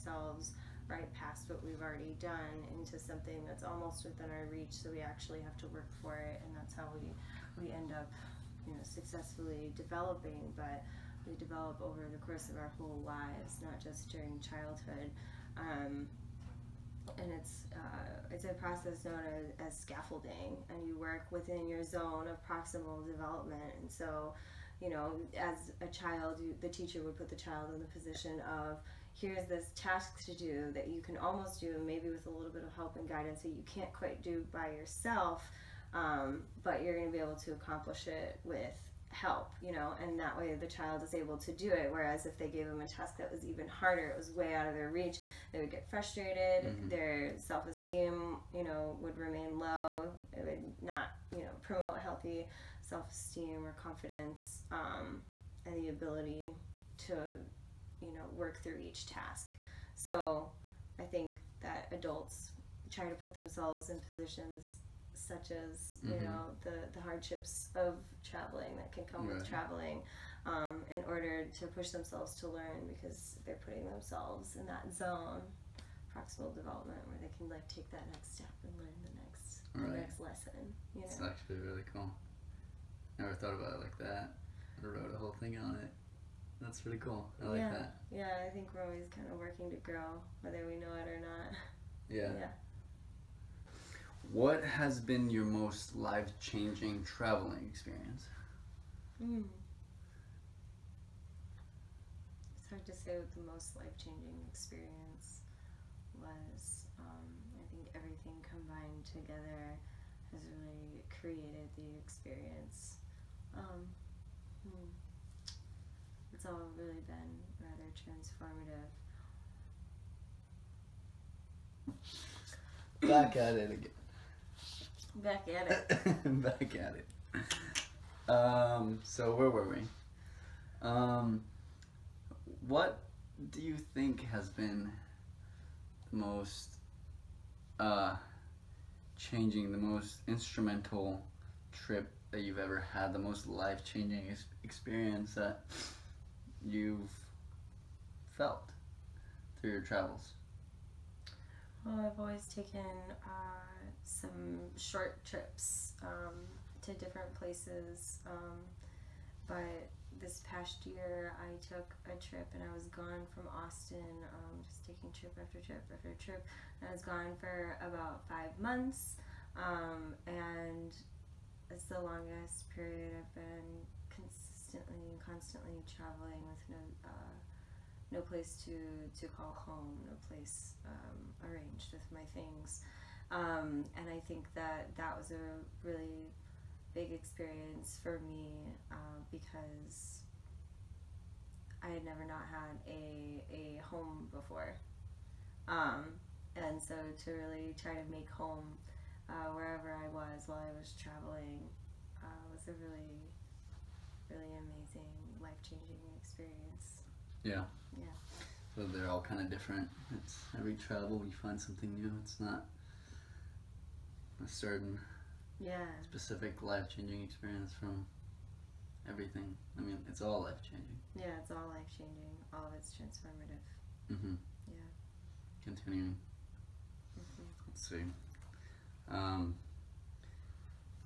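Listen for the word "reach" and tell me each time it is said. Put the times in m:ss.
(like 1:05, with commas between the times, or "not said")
0:04, 0:44.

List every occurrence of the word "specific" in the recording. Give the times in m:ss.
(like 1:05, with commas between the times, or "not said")
3:36.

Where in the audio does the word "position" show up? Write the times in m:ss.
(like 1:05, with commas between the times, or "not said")
0:27, 1:04.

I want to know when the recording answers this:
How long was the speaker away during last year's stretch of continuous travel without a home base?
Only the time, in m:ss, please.
2:48.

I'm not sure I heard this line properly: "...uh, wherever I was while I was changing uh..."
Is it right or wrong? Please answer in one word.
wrong.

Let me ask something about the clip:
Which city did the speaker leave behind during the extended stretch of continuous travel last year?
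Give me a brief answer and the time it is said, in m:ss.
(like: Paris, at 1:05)
Austin, at 2:43.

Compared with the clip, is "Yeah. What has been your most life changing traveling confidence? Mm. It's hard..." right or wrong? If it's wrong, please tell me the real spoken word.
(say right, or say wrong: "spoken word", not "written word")
wrong: "experience", not "confidence".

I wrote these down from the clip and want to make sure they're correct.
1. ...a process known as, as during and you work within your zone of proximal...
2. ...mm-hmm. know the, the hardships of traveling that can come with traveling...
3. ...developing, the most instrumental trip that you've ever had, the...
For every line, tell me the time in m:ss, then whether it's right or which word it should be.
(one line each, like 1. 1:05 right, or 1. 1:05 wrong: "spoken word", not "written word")
1. 0:18 wrong: "scaffolding", not "during"
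2. 1:06 right
3. 2:19 wrong: "changing", not "developing".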